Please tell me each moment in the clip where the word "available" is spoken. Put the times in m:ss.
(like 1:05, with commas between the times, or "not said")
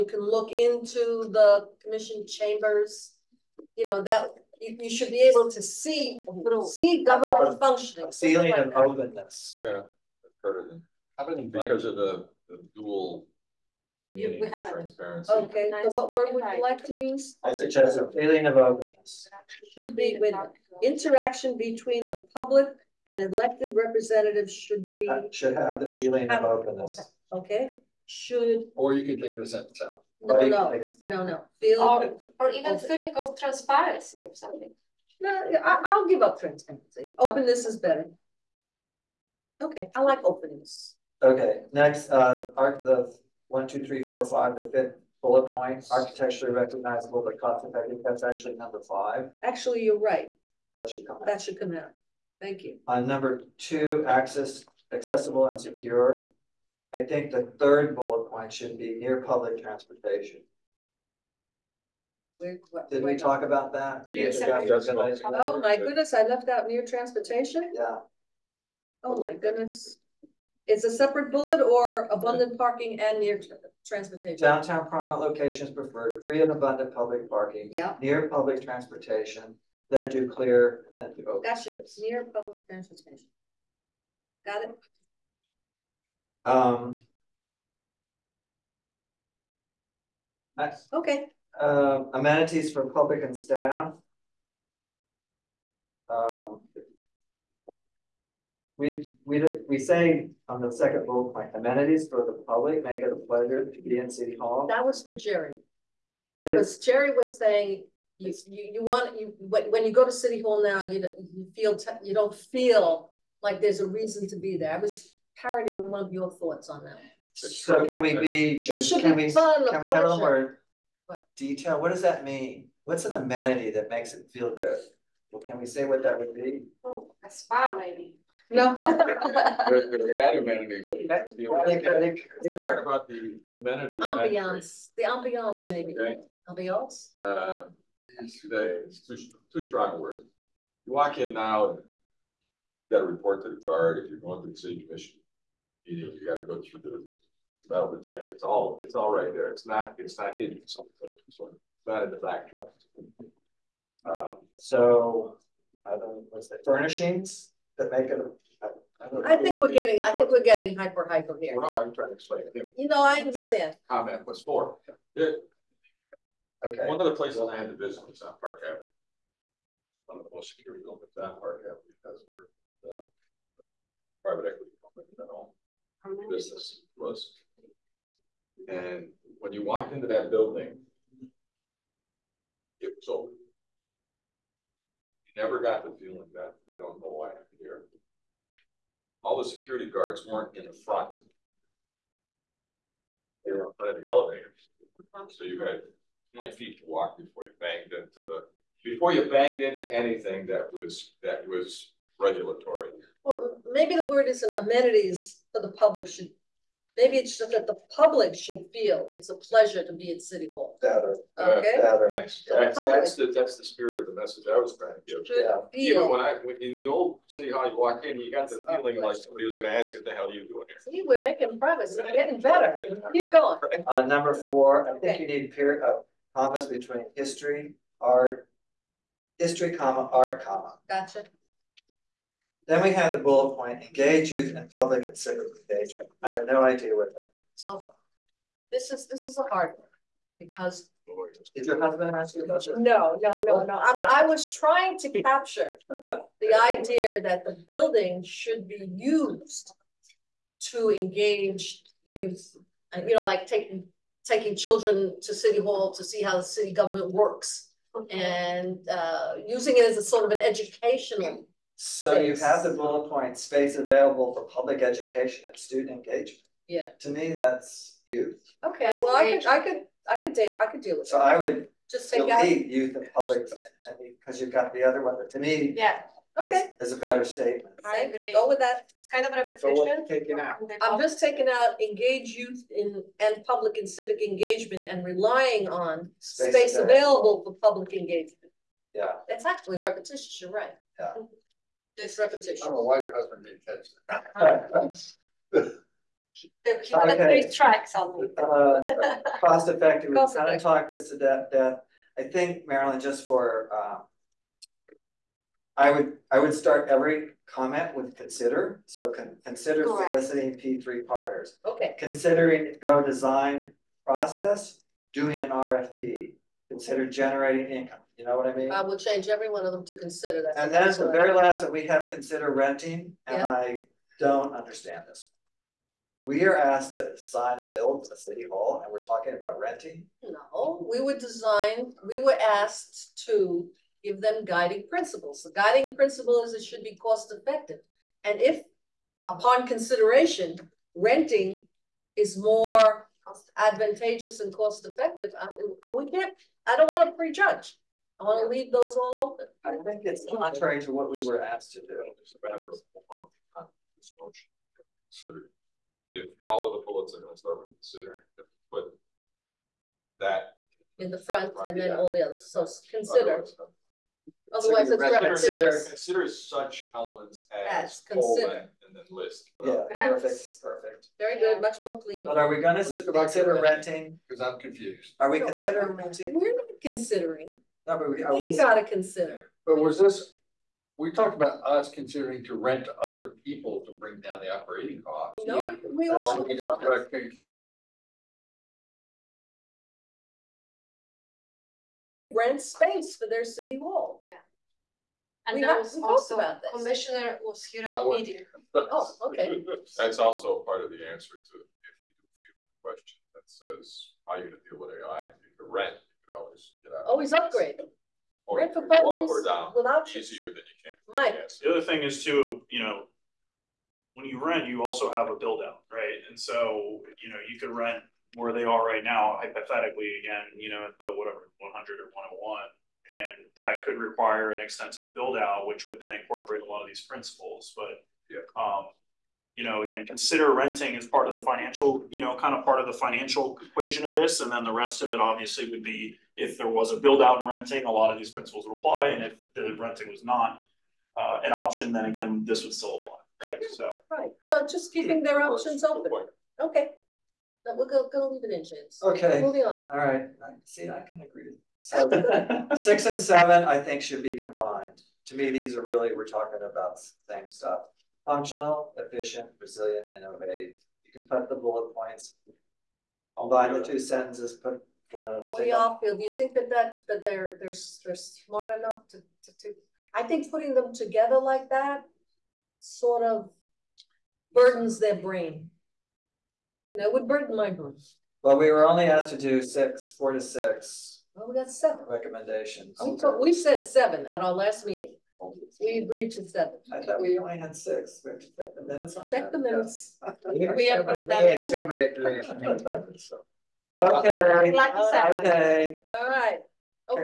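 4:23, 4:46.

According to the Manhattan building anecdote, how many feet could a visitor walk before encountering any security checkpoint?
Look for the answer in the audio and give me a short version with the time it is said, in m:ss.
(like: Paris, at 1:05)
20 feet, at 3:16.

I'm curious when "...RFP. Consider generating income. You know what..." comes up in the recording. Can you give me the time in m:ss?
5:15.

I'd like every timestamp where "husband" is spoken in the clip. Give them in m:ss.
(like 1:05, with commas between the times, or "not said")
4:01, 4:53.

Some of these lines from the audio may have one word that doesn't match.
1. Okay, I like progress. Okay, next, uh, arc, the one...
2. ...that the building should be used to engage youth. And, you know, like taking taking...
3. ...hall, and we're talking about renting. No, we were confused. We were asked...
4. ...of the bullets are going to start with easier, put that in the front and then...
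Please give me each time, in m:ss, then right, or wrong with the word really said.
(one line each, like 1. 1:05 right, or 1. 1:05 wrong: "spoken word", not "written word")
1. 0:39 wrong: "openness", not "progress"
2. 4:07 right
3. 5:28 wrong: "designed", not "confused"
4. 5:56 wrong: "consider", not "easier".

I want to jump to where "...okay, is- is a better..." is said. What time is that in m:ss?
4:36.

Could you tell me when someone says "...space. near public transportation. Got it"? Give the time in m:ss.
1:21.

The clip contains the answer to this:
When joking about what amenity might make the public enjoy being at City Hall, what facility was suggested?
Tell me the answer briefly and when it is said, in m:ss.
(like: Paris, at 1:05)
A spa, at 2:07.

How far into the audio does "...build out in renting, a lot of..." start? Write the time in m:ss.
7:16.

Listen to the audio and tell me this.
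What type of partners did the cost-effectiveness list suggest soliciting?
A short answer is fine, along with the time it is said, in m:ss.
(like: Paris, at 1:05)
P3 partners, at 5:10.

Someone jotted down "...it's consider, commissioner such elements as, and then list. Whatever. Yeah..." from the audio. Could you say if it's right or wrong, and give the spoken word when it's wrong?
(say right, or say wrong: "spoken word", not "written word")
wrong: "consider", not "commissioner".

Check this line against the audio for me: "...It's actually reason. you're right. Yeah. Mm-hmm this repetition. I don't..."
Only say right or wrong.
wrong.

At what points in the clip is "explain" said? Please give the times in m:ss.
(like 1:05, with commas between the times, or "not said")
2:42.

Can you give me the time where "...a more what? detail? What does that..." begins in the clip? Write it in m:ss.
2:00.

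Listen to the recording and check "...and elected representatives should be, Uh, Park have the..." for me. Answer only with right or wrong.
wrong.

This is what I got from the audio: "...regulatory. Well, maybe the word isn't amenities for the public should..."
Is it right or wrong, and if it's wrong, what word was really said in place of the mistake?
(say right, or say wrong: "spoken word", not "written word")
right.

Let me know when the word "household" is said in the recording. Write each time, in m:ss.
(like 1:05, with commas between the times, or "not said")
not said.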